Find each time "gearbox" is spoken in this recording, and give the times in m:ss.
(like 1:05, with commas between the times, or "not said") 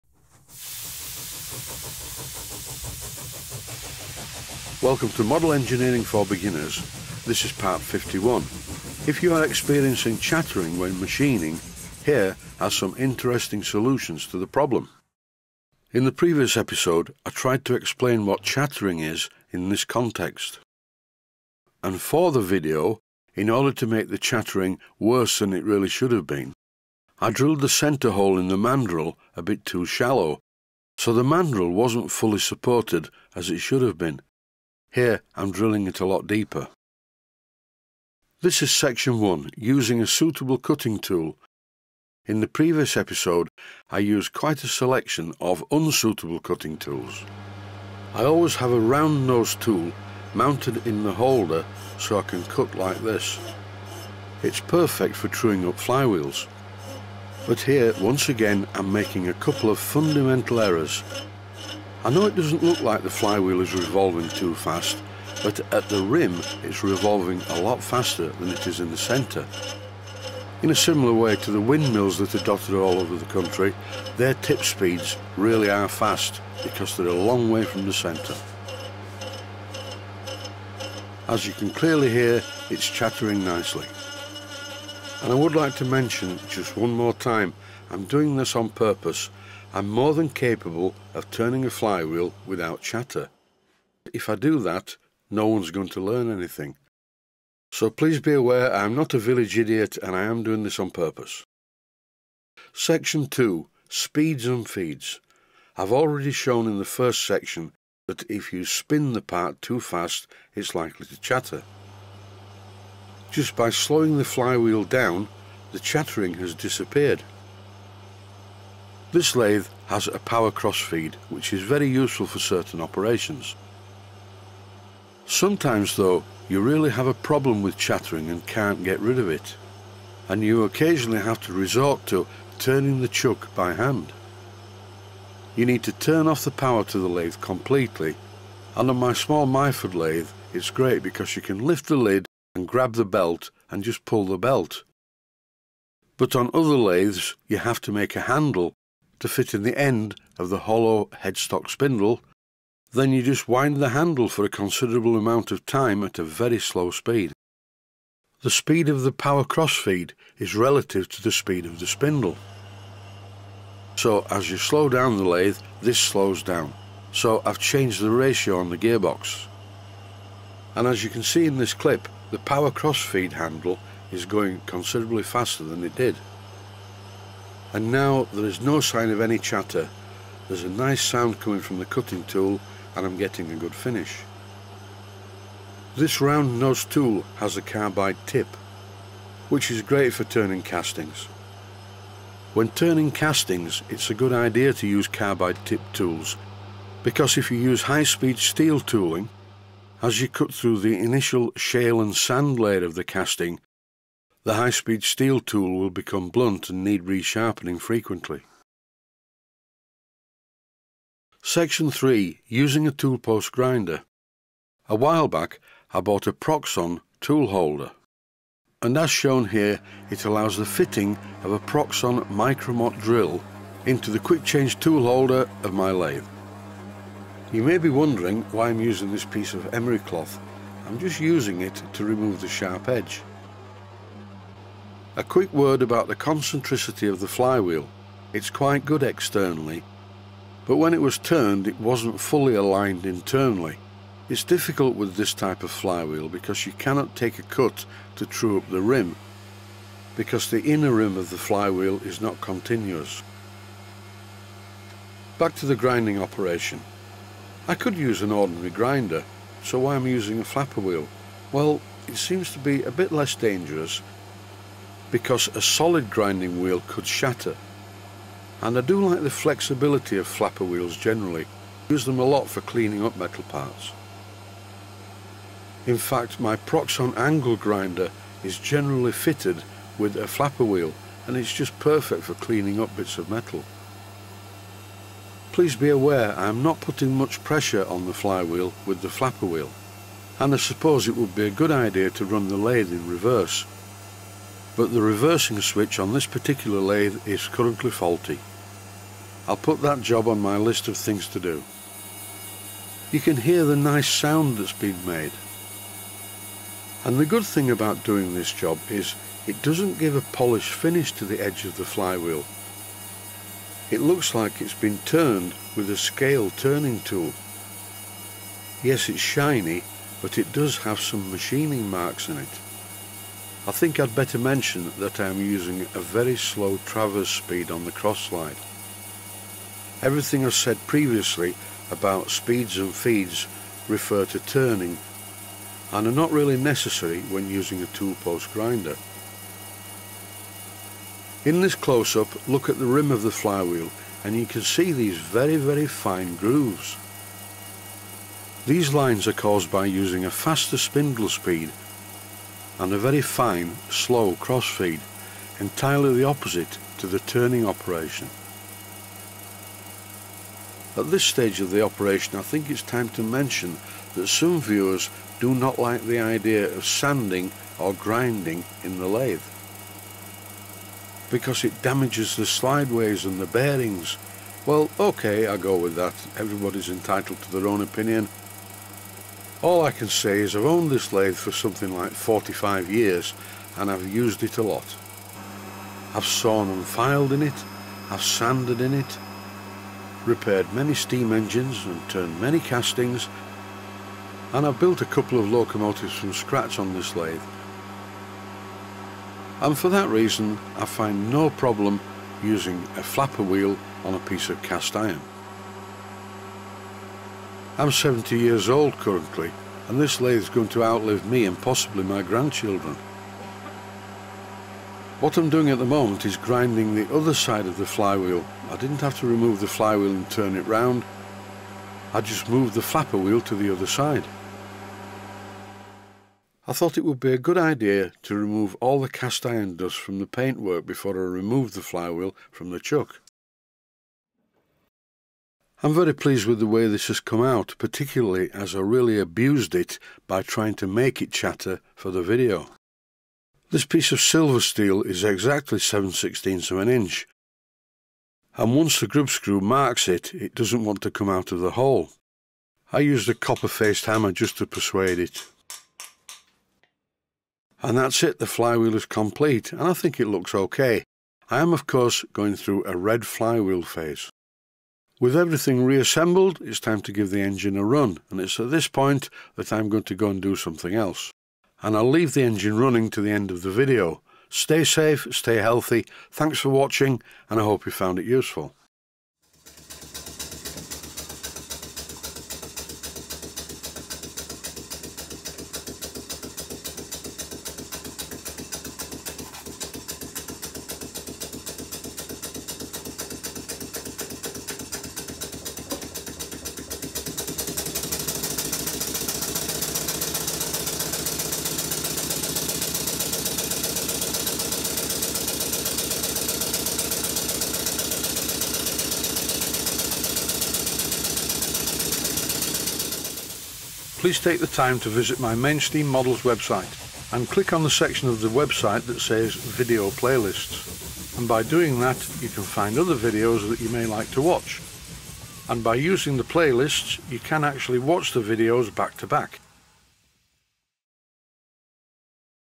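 2:48.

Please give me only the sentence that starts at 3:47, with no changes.
You may be wondering why I'm using this piece of emery cloth.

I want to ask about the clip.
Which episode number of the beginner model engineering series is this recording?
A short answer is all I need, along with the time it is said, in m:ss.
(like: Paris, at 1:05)
51, at 0:07.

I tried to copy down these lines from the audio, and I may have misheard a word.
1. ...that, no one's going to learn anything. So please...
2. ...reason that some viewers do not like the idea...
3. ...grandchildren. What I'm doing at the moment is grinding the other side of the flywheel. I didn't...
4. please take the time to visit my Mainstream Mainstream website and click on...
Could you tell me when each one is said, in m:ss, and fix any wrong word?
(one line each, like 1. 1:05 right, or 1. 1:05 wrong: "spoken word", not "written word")
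1. 1:34 right
2. 6:03 wrong: "mention", not "reason"
3. 6:52 right
4. 8:34 wrong: "Models", not "Mainstream".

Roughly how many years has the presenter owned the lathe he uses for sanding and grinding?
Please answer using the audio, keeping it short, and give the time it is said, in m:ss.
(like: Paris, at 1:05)
45, at 6:22.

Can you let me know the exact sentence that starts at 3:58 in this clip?
It's quite good externally, but when it was turned it wasn't fully aligned internally.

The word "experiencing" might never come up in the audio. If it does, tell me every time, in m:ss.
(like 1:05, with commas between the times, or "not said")
0:09.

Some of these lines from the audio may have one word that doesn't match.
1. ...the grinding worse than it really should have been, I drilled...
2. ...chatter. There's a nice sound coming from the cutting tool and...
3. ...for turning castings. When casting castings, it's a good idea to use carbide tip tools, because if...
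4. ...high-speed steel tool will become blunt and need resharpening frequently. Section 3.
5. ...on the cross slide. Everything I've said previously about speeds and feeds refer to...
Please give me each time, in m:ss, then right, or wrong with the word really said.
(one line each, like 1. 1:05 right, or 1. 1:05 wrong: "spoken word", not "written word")
1. 0:24 wrong: "chattering", not "grinding"
2. 2:59 right
3. 3:10 wrong: "turning", not "casting"
4. 3:24 right
5. 5:27 right.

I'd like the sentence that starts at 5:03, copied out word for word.
You can hear the nice sound that's been made.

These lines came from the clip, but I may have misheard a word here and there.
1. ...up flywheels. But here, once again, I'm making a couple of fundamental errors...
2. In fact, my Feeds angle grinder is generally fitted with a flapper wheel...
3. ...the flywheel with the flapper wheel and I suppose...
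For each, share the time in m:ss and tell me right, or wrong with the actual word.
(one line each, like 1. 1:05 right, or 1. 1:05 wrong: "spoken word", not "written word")
1. 0:55 right
2. 4:35 wrong: "Proxxon", not "Feeds"
3. 4:48 right.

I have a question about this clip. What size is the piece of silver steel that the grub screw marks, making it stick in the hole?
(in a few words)
7/16 inch.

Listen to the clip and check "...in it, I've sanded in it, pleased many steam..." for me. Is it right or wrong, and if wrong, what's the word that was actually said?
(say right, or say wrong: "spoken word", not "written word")
wrong: "repaired", not "pleased".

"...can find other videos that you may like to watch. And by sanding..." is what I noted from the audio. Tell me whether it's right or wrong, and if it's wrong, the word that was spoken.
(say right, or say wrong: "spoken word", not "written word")
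wrong: "using", not "sanding".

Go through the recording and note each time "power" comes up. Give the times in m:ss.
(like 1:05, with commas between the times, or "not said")
2:00, 2:16, 2:39, 2:52.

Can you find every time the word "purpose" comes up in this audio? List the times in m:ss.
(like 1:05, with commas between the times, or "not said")
1:28, 1:40.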